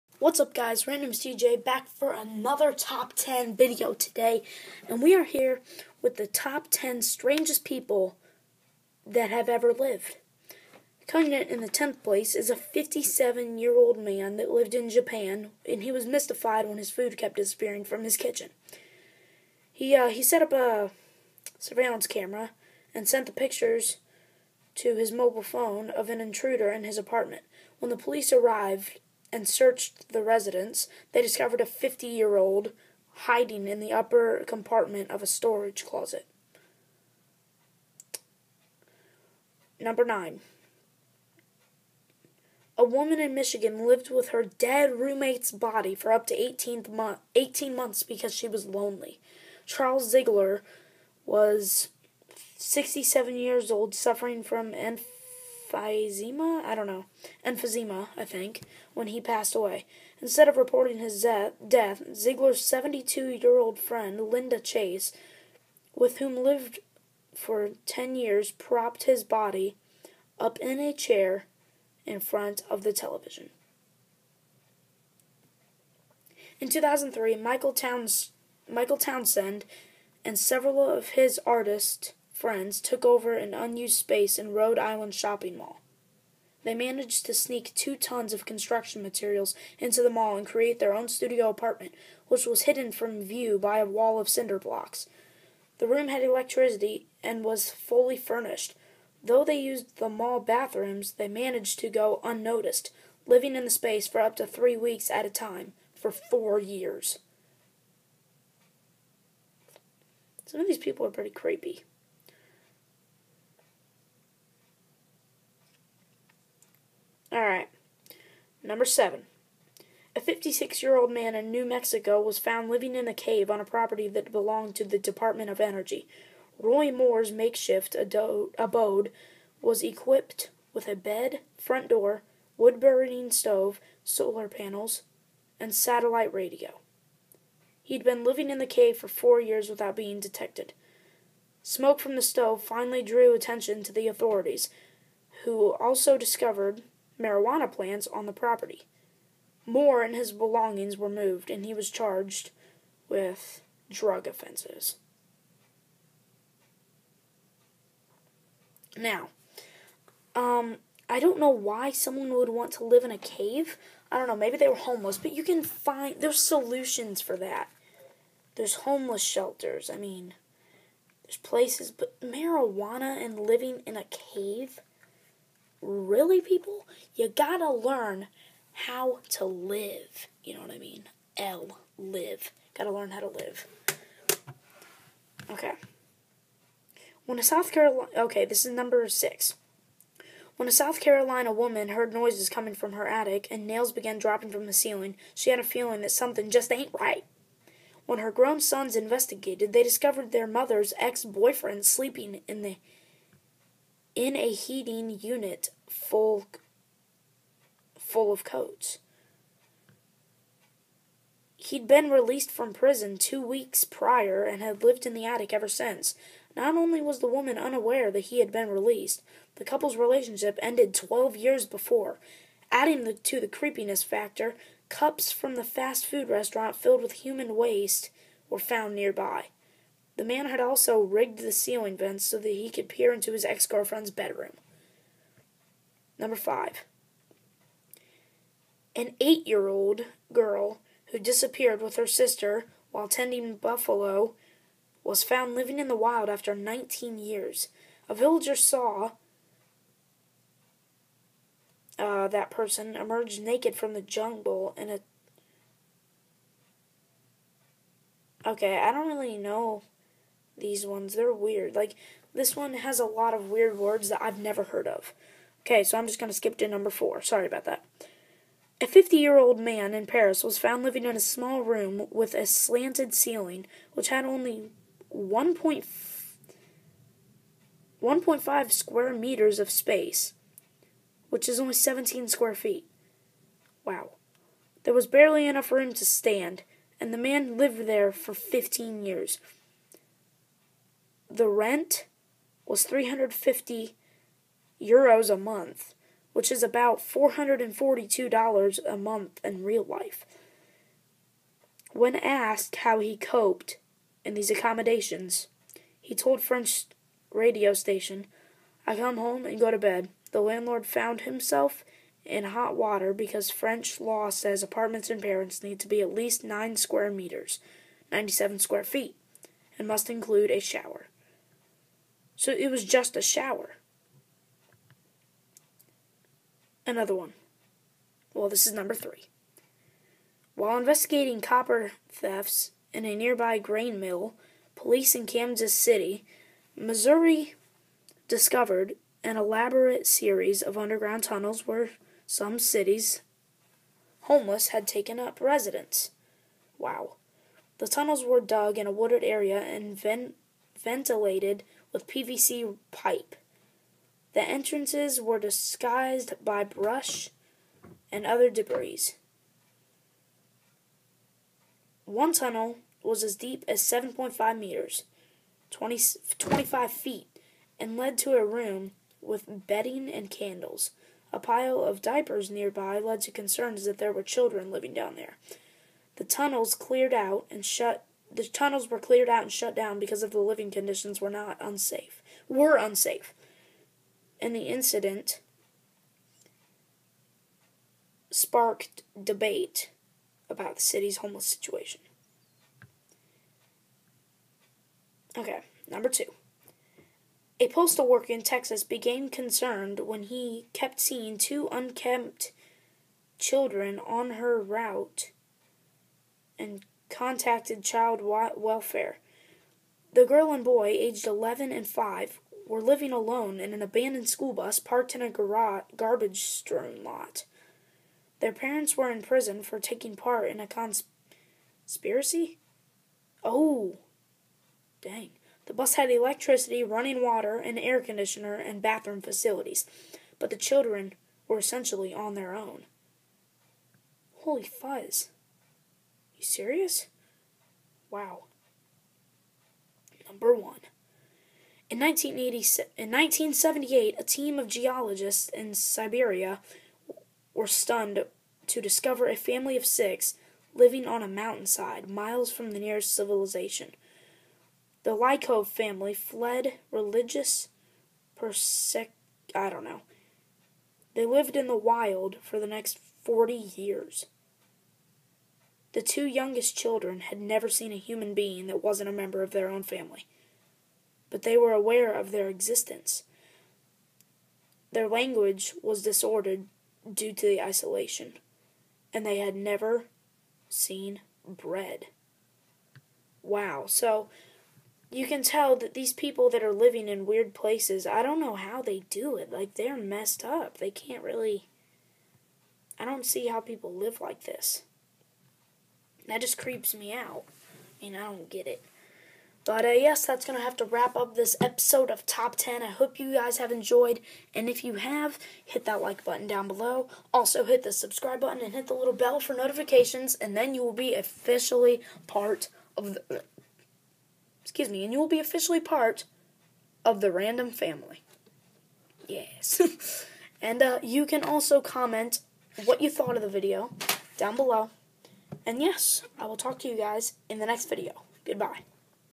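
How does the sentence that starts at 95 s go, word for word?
The room had electricity and was fully furnished.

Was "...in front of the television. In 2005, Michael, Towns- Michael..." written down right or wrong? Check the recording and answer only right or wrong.
wrong.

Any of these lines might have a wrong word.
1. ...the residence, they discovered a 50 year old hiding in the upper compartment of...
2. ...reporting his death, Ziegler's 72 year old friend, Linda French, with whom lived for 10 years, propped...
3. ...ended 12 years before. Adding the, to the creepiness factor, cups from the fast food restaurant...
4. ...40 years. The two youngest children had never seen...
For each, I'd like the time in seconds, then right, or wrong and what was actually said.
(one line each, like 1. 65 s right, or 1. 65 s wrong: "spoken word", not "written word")
1. 30 s right
2. 60 s wrong: "Chase", not "French"
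3. 220 s right
4. 463 s right.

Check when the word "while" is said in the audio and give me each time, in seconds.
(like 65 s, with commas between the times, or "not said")
242 s, 330 s.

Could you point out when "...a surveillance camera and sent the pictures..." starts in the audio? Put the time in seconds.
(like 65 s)
20 s.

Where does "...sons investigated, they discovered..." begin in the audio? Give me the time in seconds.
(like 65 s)
198 s.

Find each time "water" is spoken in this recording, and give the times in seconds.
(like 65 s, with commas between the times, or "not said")
312 s, 427 s.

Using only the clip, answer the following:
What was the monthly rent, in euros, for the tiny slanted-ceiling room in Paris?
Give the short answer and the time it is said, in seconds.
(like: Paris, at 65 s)
350 euros, at 292 s.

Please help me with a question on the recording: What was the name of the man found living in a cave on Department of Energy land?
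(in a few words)
Roy Moore.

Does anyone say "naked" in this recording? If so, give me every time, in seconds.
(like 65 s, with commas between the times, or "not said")
253 s.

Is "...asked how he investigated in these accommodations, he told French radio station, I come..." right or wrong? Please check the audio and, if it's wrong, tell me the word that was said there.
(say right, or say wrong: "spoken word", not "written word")
wrong: "coped", not "investigated".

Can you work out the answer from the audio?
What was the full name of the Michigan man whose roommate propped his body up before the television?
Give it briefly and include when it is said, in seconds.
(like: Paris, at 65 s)
Charles Ziegler, at 49 s.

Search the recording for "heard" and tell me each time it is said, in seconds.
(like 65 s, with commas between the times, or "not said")
191 s, 264 s.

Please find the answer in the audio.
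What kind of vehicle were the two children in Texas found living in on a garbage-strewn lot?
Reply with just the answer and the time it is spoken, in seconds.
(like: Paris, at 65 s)
school bus, at 414 s.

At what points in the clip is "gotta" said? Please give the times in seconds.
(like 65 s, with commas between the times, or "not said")
177 s, 182 s.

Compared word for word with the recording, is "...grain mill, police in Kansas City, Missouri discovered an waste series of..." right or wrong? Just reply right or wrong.
wrong.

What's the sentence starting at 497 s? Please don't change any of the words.
I mean, I don't get it.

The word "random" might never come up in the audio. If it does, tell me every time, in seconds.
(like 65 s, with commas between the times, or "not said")
0 s, 517 s.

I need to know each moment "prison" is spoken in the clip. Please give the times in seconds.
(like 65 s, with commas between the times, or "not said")
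212 s, 419 s.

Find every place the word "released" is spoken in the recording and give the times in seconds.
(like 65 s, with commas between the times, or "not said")
212 s, 218 s.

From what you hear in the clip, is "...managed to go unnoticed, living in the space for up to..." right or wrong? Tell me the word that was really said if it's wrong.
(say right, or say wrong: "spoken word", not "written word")
right.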